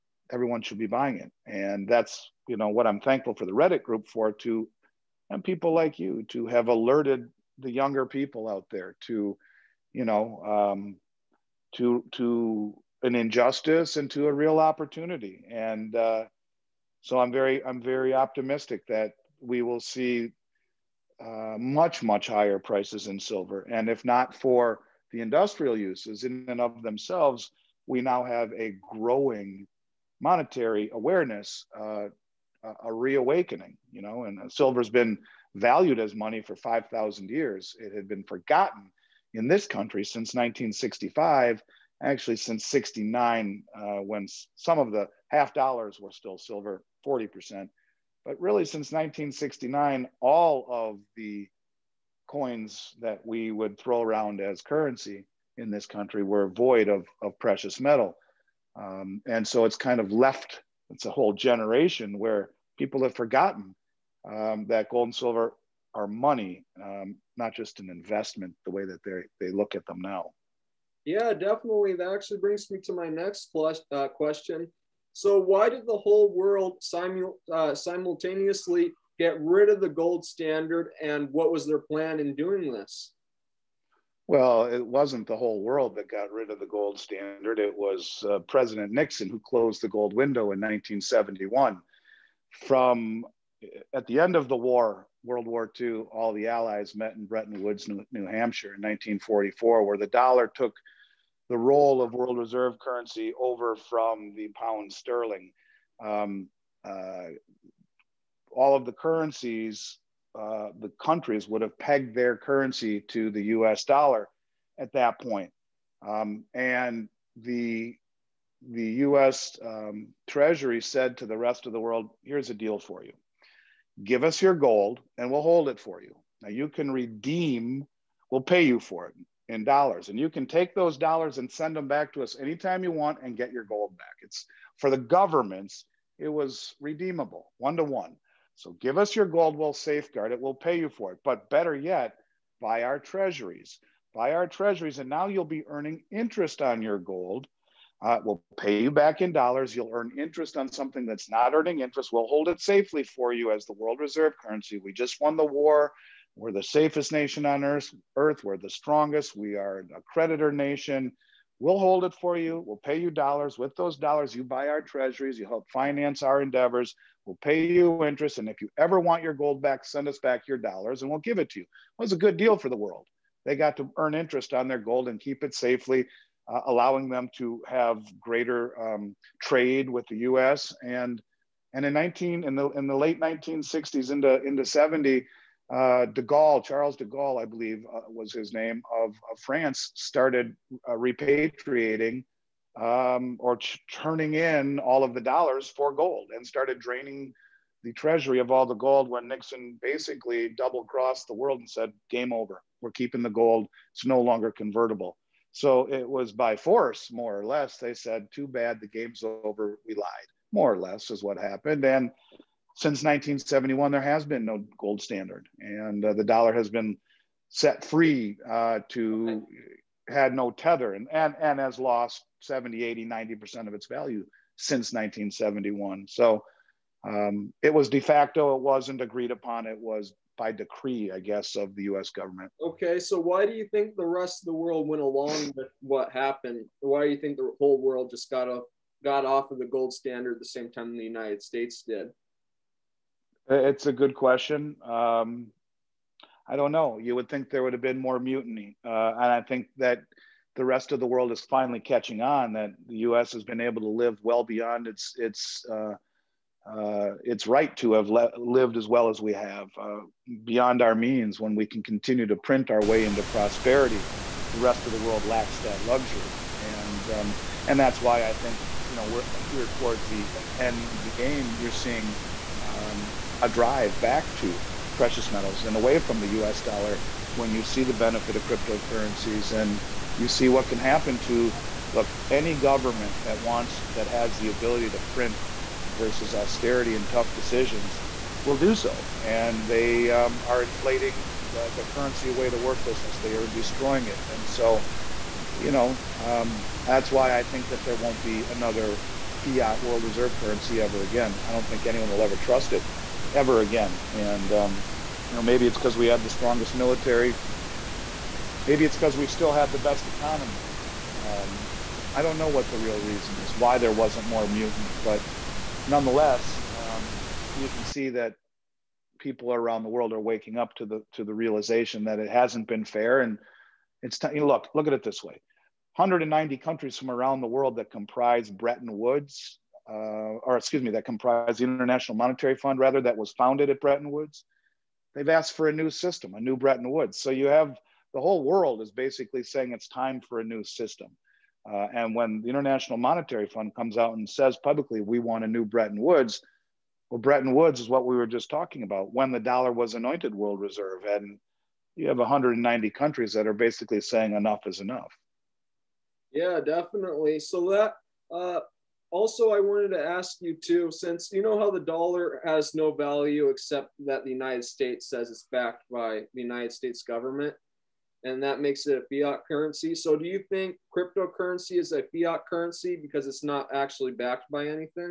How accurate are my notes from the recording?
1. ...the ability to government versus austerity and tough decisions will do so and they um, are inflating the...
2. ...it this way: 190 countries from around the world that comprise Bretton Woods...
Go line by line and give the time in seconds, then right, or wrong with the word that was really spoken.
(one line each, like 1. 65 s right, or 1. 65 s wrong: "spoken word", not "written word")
1. 284 s wrong: "print", not "government"
2. 324 s right.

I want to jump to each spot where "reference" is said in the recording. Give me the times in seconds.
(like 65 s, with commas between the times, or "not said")
not said.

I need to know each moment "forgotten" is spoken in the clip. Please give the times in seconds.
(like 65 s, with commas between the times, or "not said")
38 s, 63 s.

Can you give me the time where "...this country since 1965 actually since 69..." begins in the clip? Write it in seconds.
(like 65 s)
39 s.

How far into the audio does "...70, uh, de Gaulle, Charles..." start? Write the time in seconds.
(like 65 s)
184 s.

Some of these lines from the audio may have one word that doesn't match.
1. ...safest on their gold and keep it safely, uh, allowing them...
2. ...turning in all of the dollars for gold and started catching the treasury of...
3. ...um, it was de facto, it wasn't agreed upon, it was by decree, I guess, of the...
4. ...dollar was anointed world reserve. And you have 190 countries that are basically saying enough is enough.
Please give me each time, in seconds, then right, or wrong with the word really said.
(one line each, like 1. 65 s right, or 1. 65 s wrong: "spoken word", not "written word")
1. 174 s wrong: "interest", not "safest"
2. 193 s wrong: "draining", not "catching"
3. 227 s right
4. 349 s right.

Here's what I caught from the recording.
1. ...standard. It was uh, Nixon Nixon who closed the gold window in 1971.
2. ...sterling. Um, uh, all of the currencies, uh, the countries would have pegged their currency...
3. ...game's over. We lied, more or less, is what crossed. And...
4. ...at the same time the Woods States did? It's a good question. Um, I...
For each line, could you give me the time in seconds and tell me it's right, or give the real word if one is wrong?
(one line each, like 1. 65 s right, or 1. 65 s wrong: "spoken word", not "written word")
1. 86 s wrong: "President", not "Nixon"
2. 104 s right
3. 208 s wrong: "happened", not "crossed"
4. 240 s wrong: "United", not "Woods".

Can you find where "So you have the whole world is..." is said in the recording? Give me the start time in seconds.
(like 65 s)
337 s.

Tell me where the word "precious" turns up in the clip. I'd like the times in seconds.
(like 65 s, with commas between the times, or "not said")
57 s, 274 s.